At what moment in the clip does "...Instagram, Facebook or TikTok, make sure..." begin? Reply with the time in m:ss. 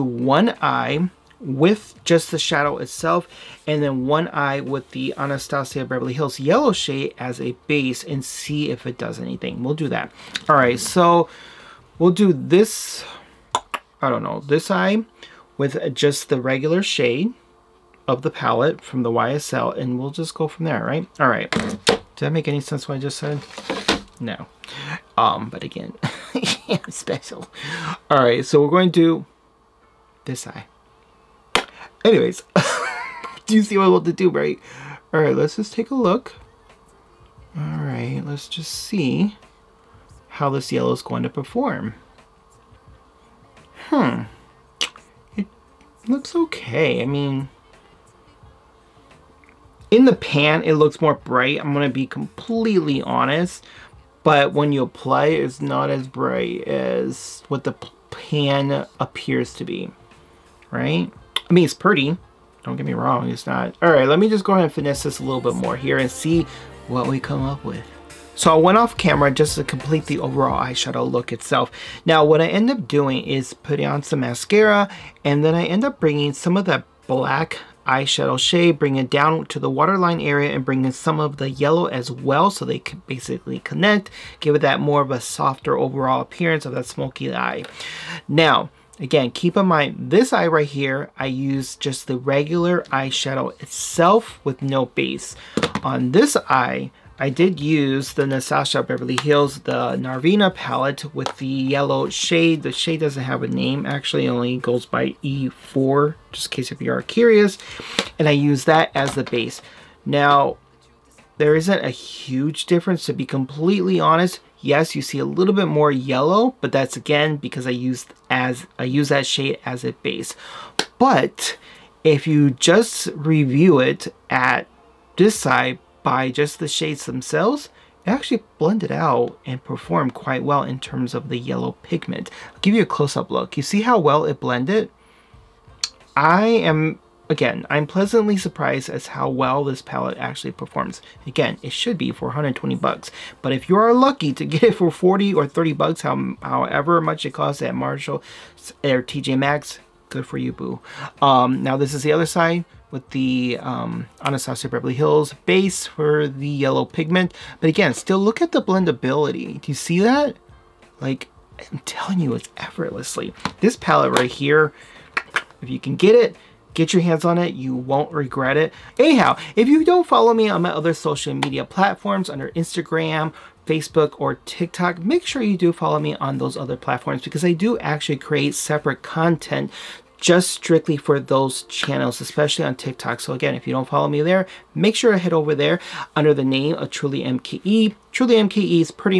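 2:52.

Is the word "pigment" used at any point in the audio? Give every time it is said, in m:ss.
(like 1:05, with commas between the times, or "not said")
2:11, 2:36.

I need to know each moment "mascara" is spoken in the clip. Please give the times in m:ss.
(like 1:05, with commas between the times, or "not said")
1:14.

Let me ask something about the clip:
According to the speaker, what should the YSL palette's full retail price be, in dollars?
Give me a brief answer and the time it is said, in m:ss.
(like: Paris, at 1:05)
120, at 2:22.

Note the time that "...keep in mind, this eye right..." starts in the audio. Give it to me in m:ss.
1:29.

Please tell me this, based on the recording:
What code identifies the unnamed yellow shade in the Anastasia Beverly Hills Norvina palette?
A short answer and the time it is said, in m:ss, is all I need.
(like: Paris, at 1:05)
E4, at 1:45.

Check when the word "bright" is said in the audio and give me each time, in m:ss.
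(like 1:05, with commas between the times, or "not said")
0:51, 0:56.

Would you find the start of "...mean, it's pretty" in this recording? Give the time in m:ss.
1:01.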